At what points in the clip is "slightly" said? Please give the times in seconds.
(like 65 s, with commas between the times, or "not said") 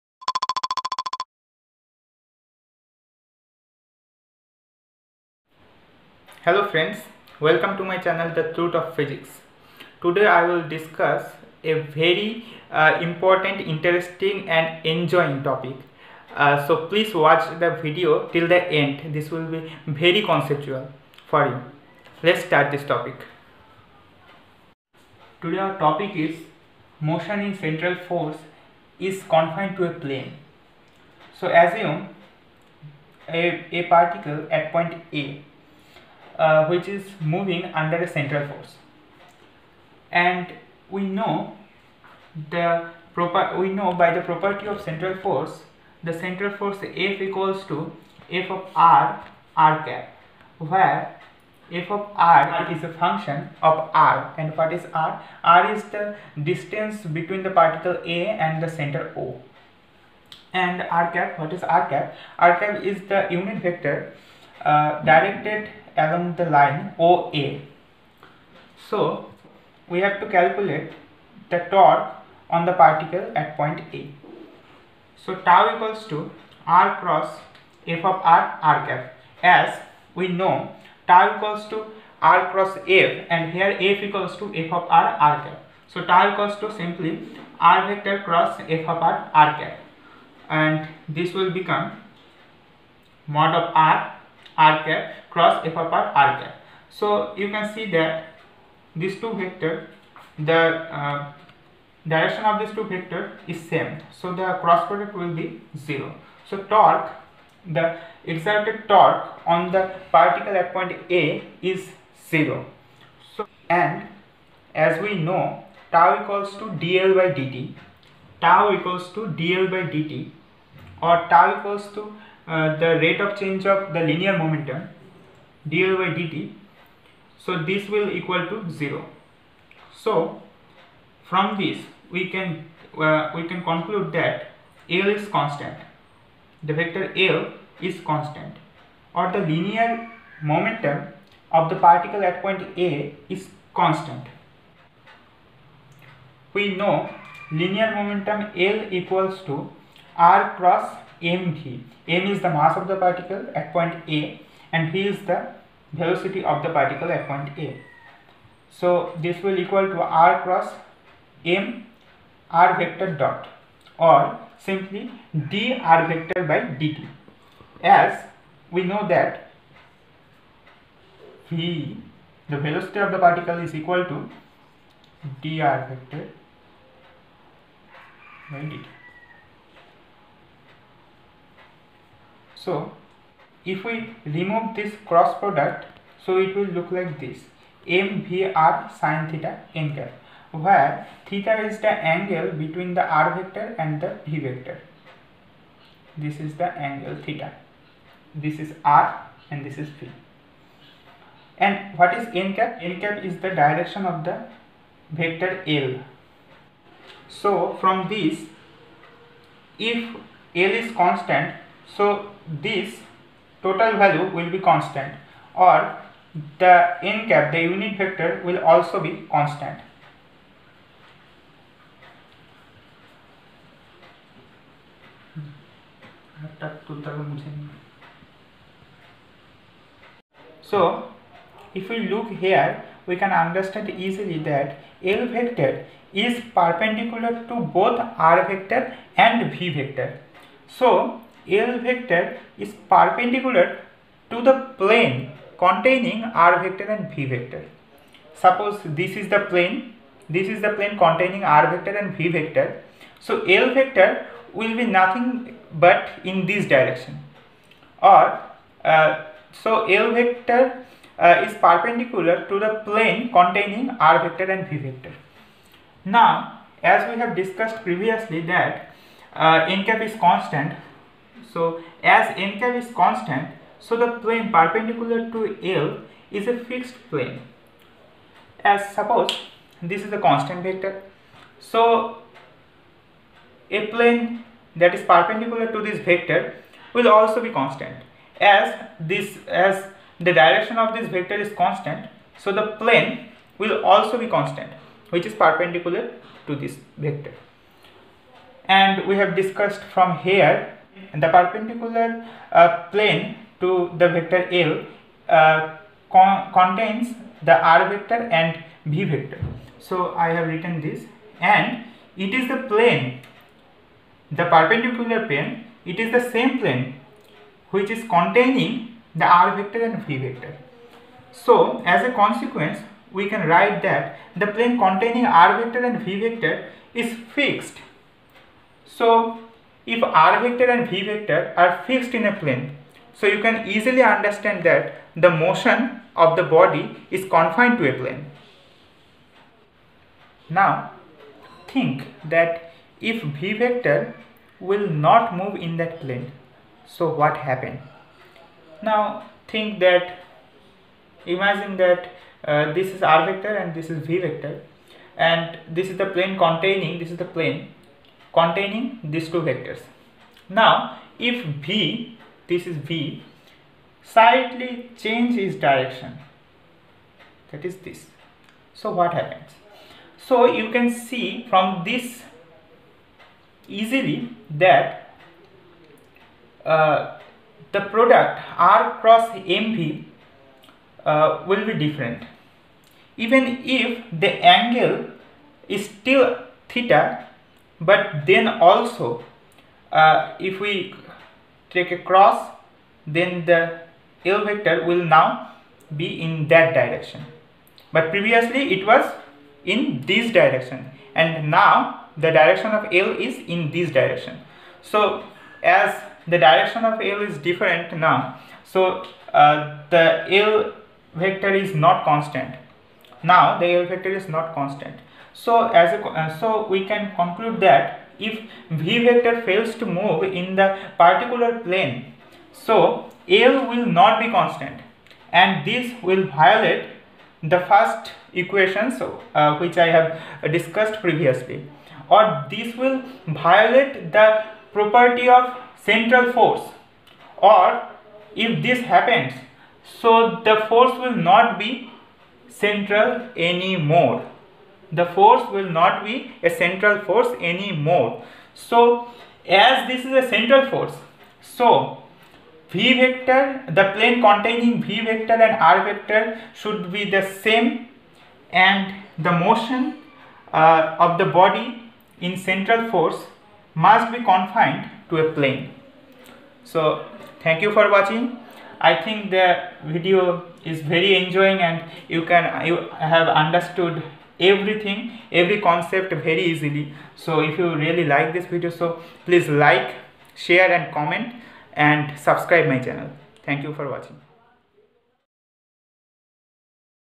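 364 s.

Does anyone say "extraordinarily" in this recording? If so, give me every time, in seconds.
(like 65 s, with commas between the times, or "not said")
not said.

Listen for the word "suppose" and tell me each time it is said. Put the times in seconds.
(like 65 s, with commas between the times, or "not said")
248 s, 278 s.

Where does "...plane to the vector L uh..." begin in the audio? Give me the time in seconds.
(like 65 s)
302 s.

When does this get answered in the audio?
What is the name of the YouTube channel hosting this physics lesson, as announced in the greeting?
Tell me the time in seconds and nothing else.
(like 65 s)
8 s.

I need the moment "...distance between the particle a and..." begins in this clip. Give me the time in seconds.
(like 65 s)
56 s.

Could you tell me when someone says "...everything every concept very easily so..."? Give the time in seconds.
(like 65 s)
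474 s.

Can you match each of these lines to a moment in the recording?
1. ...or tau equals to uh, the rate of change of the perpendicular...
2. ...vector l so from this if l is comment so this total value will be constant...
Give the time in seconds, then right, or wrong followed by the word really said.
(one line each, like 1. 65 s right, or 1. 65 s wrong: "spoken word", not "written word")
1. 121 s wrong: "linear", not "perpendicular"
2. 205 s wrong: "constant", not "comment".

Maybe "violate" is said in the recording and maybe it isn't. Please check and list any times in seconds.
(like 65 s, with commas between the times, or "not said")
426 s, 433 s.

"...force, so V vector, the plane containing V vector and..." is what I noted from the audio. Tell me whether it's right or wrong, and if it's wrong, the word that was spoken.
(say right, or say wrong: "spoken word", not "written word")
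right.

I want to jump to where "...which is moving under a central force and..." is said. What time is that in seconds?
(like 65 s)
36 s.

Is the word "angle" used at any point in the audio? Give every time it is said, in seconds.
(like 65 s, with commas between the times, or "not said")
192 s, 196 s, 384 s.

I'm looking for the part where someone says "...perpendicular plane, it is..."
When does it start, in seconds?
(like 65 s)
314 s.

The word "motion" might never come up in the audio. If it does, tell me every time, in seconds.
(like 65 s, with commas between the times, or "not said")
26 s, 335 s, 459 s.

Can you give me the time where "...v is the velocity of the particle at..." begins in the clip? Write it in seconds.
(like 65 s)
154 s.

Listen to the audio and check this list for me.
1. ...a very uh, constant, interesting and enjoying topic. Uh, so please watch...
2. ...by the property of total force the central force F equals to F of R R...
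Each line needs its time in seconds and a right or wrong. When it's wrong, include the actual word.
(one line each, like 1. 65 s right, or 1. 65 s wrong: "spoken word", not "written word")
1. 11 s wrong: "important", not "constant"
2. 44 s wrong: "central", not "total".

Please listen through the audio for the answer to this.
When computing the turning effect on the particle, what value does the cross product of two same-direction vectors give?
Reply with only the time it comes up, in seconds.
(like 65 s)
104 s.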